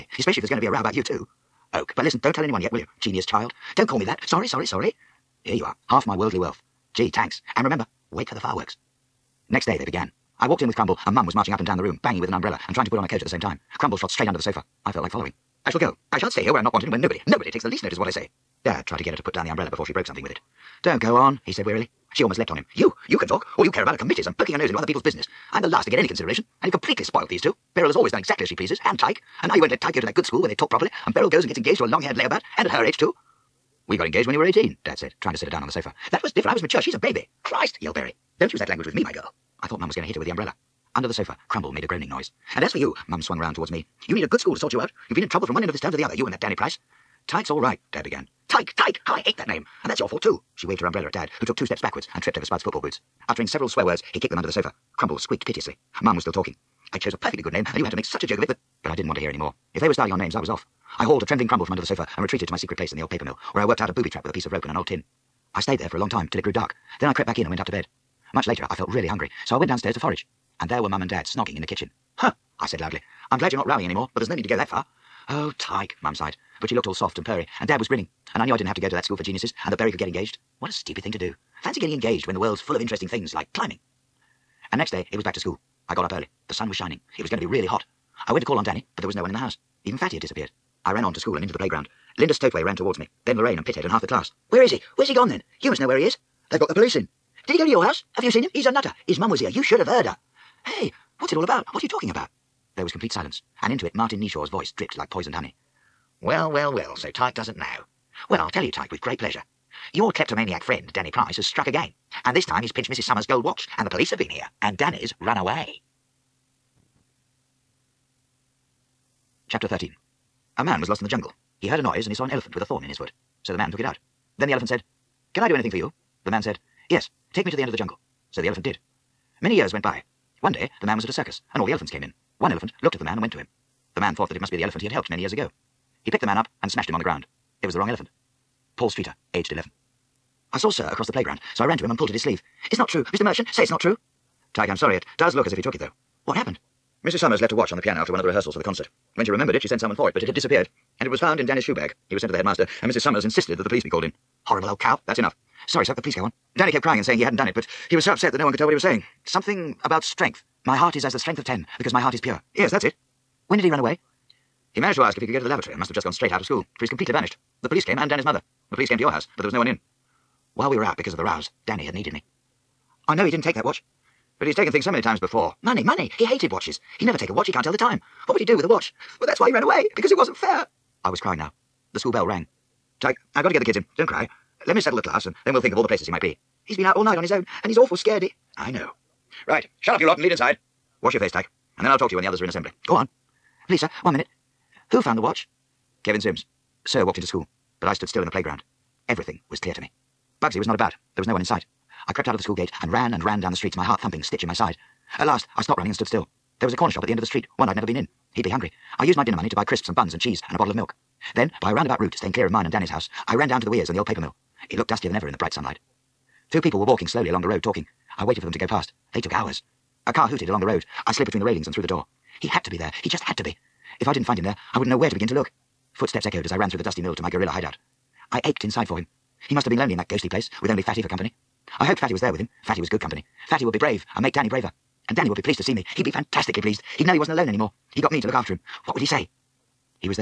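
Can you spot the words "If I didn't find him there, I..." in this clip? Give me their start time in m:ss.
3:44.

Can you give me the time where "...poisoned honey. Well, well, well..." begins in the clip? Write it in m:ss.
1:45.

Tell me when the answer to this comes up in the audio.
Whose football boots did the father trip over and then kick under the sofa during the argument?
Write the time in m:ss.
0:52.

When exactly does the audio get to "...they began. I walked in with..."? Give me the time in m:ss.
0:09.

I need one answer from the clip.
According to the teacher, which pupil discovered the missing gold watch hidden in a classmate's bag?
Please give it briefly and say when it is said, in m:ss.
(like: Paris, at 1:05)
Kevin Sims, at 3:16.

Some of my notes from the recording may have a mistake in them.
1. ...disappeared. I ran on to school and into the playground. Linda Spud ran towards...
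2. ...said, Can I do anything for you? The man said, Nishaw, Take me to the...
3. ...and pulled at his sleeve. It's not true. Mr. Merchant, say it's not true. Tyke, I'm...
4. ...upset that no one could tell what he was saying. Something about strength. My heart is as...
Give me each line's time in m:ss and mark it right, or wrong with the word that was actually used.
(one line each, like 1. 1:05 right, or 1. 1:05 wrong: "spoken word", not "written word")
1. 1:30 wrong: "Stowtway", not "Spud"
2. 2:04 wrong: "Yes", not "Nishaw"
3. 2:21 right
4. 2:38 right.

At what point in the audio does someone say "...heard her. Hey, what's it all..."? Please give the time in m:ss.
1:39.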